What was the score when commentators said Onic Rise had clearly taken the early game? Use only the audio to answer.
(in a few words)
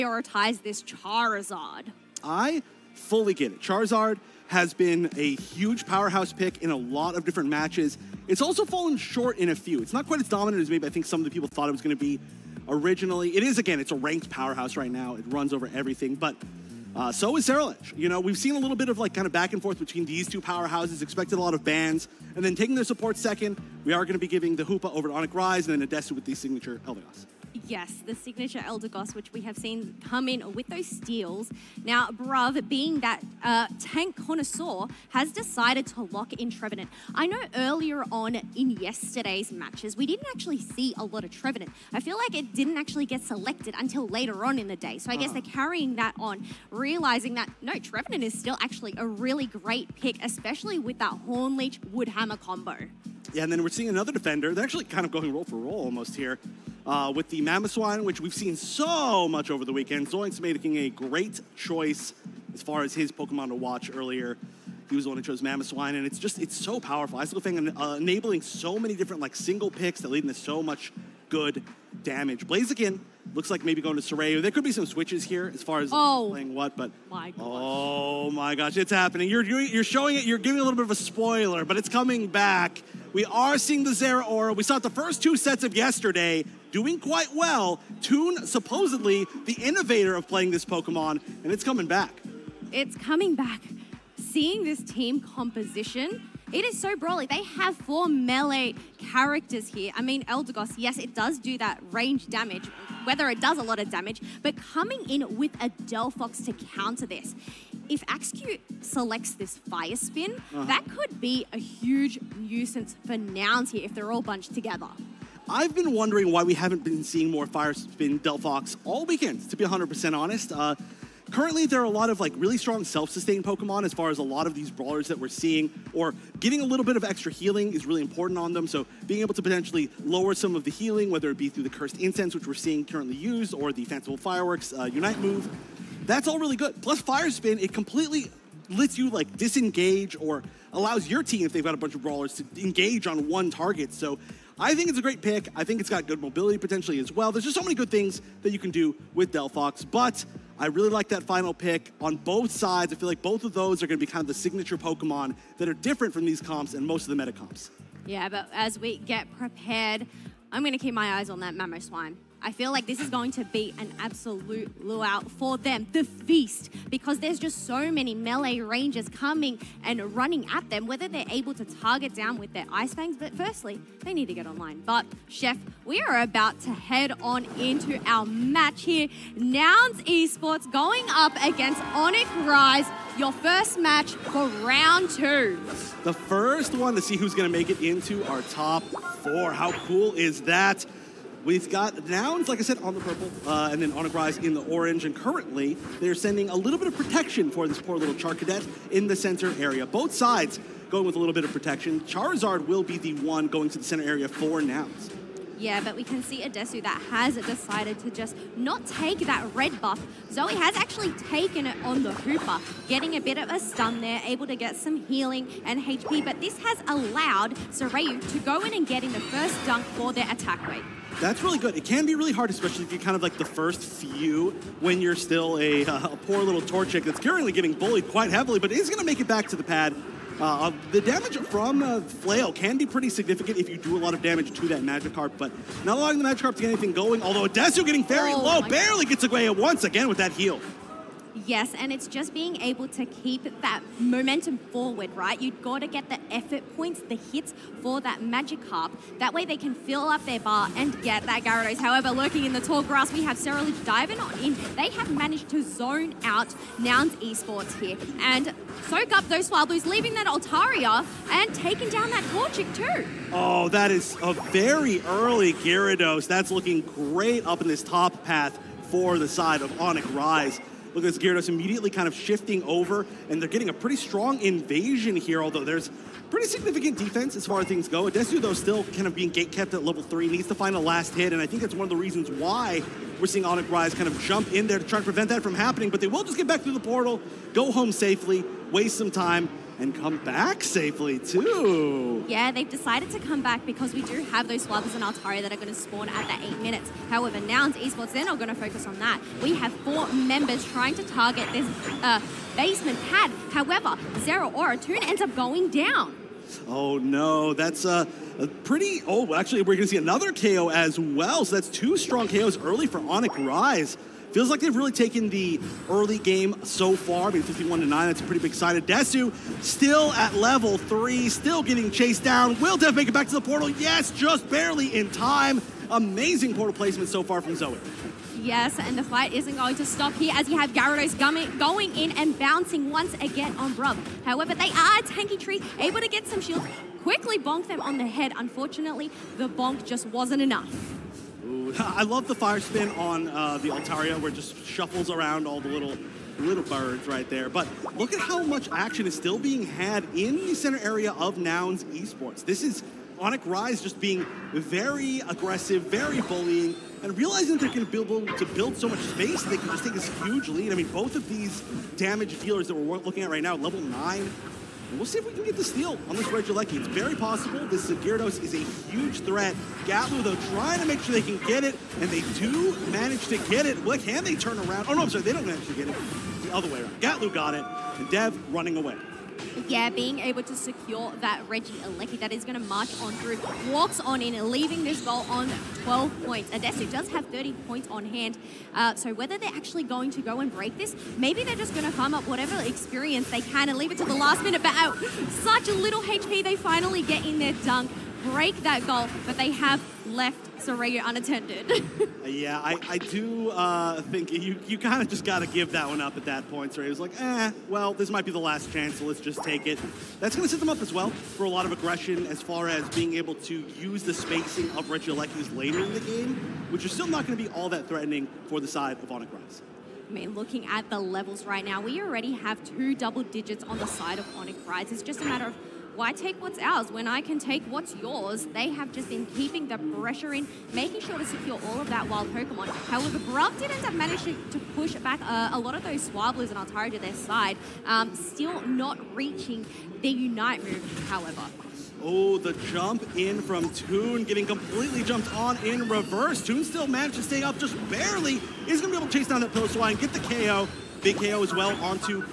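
51 to 9.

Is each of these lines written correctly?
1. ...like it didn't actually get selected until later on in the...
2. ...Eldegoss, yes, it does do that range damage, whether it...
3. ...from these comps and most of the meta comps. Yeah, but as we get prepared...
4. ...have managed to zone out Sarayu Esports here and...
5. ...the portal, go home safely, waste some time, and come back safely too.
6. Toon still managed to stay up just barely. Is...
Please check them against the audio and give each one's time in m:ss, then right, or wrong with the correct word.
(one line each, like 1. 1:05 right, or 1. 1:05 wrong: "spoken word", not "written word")
1. 0:42 right
2. 1:40 right
3. 2:36 right
4. 4:14 wrong: "Nouns", not "Sarayu"
5. 4:46 right
6. 7:26 right.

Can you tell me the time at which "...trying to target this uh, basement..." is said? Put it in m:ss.
5:00.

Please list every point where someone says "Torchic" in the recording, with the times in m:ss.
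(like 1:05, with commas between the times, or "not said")
3:46, 4:22.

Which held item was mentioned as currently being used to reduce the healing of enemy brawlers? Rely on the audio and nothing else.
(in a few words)
Cursed Incense.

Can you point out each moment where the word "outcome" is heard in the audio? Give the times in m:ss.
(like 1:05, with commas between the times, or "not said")
not said.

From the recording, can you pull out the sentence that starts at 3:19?
Both sides going with a little bit of protection.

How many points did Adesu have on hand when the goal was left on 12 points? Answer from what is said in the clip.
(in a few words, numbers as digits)
30.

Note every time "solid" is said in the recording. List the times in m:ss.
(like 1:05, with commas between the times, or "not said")
not said.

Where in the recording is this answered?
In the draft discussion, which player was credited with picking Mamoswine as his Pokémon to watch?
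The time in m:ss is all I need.
1:00.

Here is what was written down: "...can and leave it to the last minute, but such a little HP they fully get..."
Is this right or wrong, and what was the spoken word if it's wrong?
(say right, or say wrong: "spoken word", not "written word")
wrong: "finally", not "fully".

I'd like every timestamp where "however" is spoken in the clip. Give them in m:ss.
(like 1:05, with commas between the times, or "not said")
4:11, 4:57, 5:03, 5:34, 7:12, 7:21.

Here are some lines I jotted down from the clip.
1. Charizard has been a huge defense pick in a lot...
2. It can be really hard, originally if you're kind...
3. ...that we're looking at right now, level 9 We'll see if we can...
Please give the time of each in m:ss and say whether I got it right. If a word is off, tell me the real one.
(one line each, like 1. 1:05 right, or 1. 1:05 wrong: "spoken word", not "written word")
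1. 0:03 wrong: "powerhouse", not "defense"
2. 3:41 wrong: "especially", not "originally"
3. 6:02 right.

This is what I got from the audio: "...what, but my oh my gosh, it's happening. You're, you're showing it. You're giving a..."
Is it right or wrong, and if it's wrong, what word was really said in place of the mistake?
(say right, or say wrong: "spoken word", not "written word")
right.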